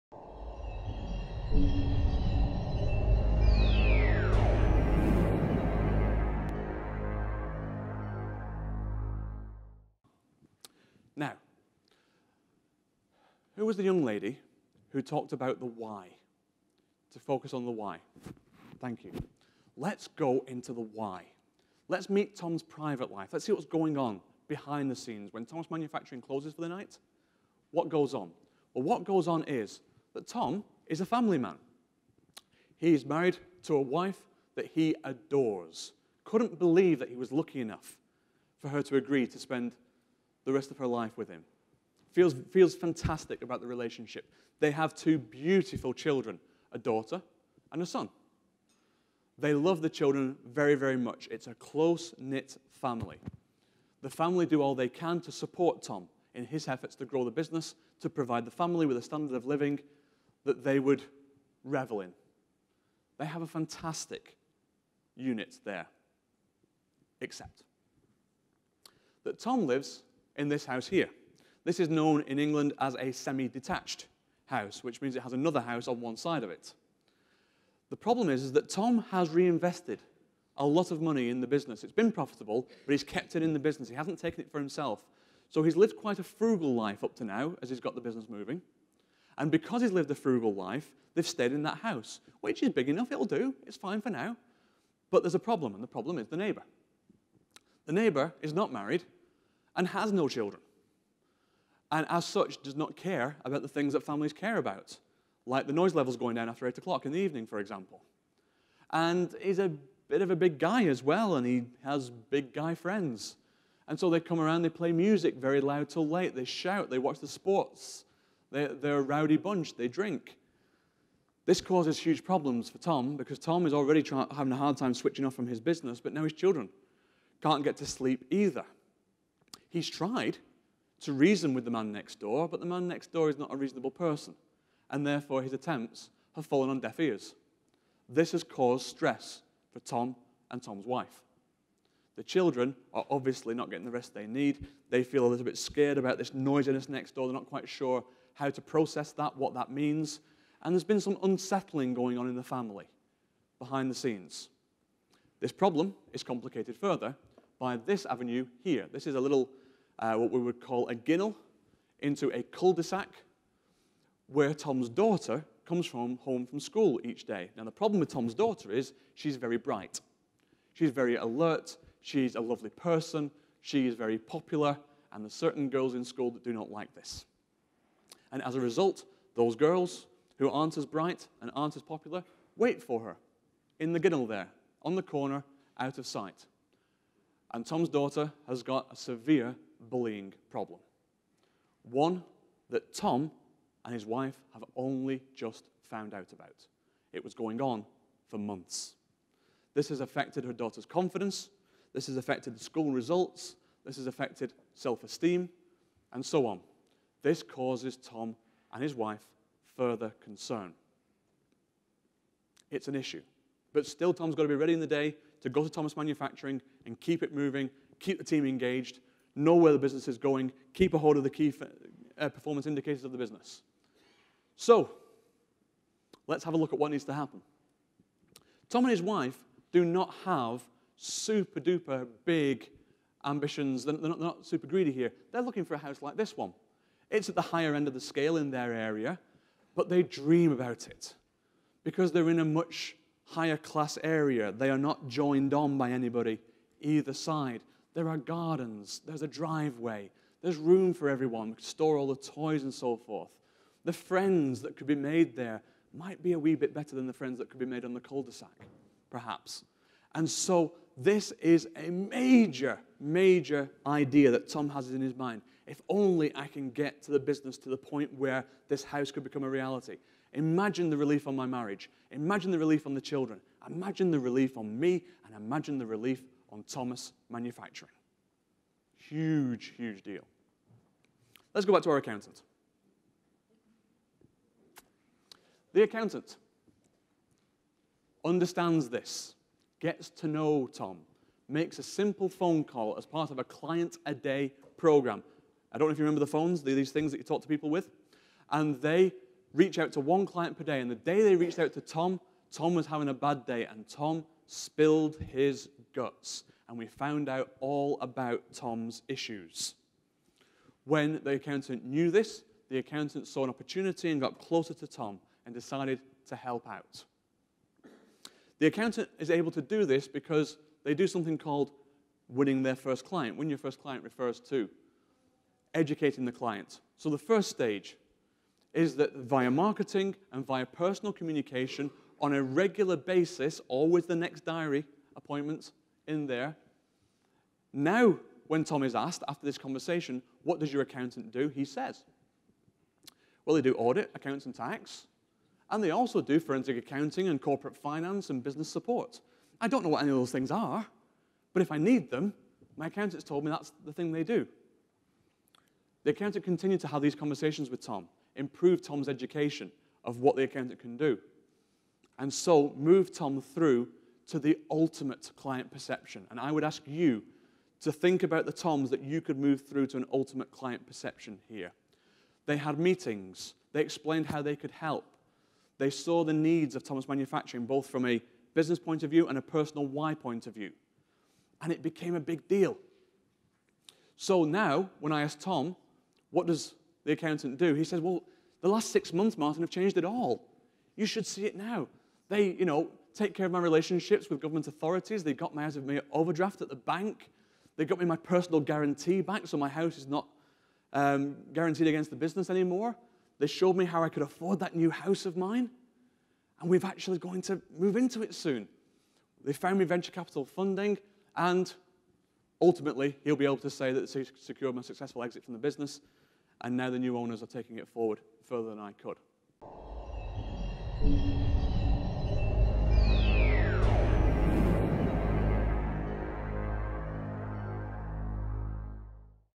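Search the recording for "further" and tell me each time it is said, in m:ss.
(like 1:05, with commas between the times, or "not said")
2:36, 3:29, 6:58.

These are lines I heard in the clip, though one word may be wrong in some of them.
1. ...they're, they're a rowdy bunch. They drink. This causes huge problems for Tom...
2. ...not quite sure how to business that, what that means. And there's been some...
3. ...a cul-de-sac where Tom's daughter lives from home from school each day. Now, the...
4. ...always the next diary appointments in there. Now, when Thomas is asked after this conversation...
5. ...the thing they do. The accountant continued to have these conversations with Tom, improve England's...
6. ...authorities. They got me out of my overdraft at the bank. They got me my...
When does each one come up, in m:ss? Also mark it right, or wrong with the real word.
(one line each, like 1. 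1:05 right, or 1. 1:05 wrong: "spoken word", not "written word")
1. 1:58 right
2. 2:27 wrong: "process", not "business"
3. 2:42 wrong: "comes", not "lives"
4. 5:33 wrong: "Tom", not "Thomas"
5. 5:53 wrong: "Tom", not "England"
6. 6:34 right.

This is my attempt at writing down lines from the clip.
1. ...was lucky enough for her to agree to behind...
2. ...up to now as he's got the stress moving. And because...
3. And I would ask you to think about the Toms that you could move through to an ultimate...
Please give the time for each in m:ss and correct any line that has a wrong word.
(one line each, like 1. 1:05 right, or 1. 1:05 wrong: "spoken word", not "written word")
1. 0:37 wrong: "spend", not "behind"
2. 1:27 wrong: "business", not "stress"
3. 6:06 right.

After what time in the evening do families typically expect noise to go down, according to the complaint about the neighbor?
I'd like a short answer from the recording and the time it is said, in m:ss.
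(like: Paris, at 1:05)
8 o'clock, at 1:46.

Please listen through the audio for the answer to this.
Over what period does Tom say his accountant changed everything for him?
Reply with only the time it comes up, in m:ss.
6:28.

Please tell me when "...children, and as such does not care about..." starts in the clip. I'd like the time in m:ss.
1:40.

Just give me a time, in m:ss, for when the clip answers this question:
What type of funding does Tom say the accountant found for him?
6:49.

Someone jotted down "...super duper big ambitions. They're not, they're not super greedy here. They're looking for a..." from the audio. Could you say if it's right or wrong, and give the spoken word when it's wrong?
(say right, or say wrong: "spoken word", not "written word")
right.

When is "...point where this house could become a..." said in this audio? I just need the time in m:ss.
4:27.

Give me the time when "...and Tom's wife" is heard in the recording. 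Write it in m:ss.
2:20.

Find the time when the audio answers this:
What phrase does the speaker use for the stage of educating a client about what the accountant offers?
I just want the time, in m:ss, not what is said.
5:22.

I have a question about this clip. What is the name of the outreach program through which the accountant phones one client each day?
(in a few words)
client a day program.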